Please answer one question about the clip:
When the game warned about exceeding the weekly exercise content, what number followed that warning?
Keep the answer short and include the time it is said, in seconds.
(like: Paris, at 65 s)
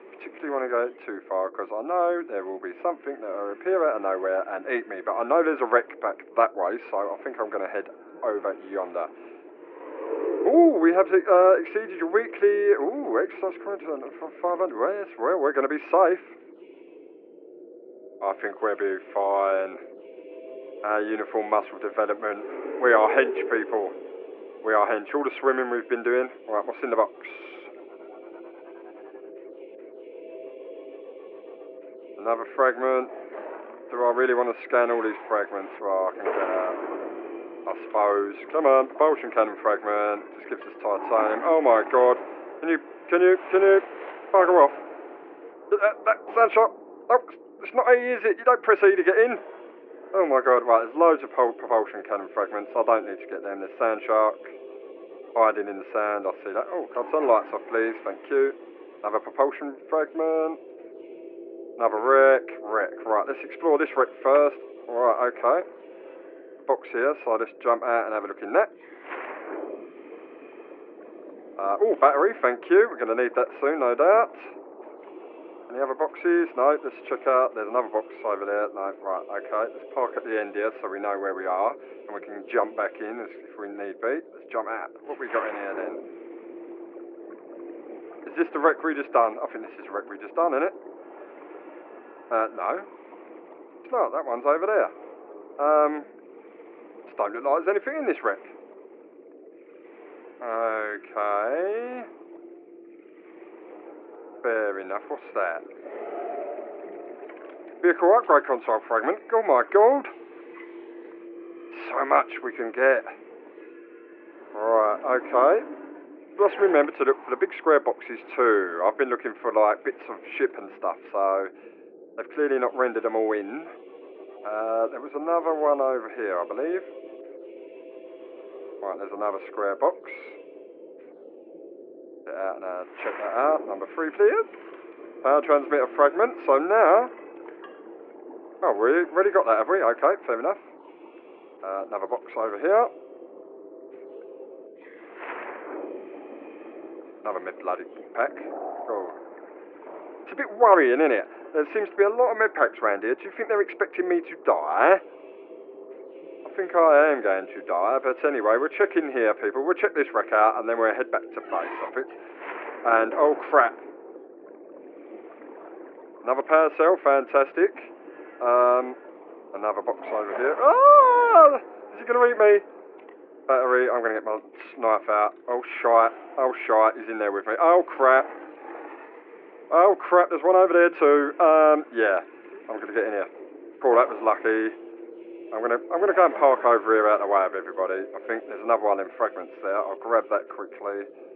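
500, at 14 s.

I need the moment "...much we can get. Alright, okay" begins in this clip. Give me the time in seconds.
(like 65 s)
112 s.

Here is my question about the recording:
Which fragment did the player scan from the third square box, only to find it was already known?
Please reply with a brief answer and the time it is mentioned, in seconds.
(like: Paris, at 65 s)
Power transmitter, at 135 s.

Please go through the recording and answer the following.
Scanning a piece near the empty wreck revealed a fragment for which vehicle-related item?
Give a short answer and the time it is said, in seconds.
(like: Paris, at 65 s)
Vehicle upgrade console, at 107 s.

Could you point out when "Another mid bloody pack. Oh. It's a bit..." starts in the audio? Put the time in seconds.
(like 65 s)
147 s.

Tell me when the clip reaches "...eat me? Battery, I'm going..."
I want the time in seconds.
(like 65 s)
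172 s.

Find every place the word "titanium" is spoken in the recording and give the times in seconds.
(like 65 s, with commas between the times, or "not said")
40 s.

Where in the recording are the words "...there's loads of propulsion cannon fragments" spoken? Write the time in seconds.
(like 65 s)
50 s.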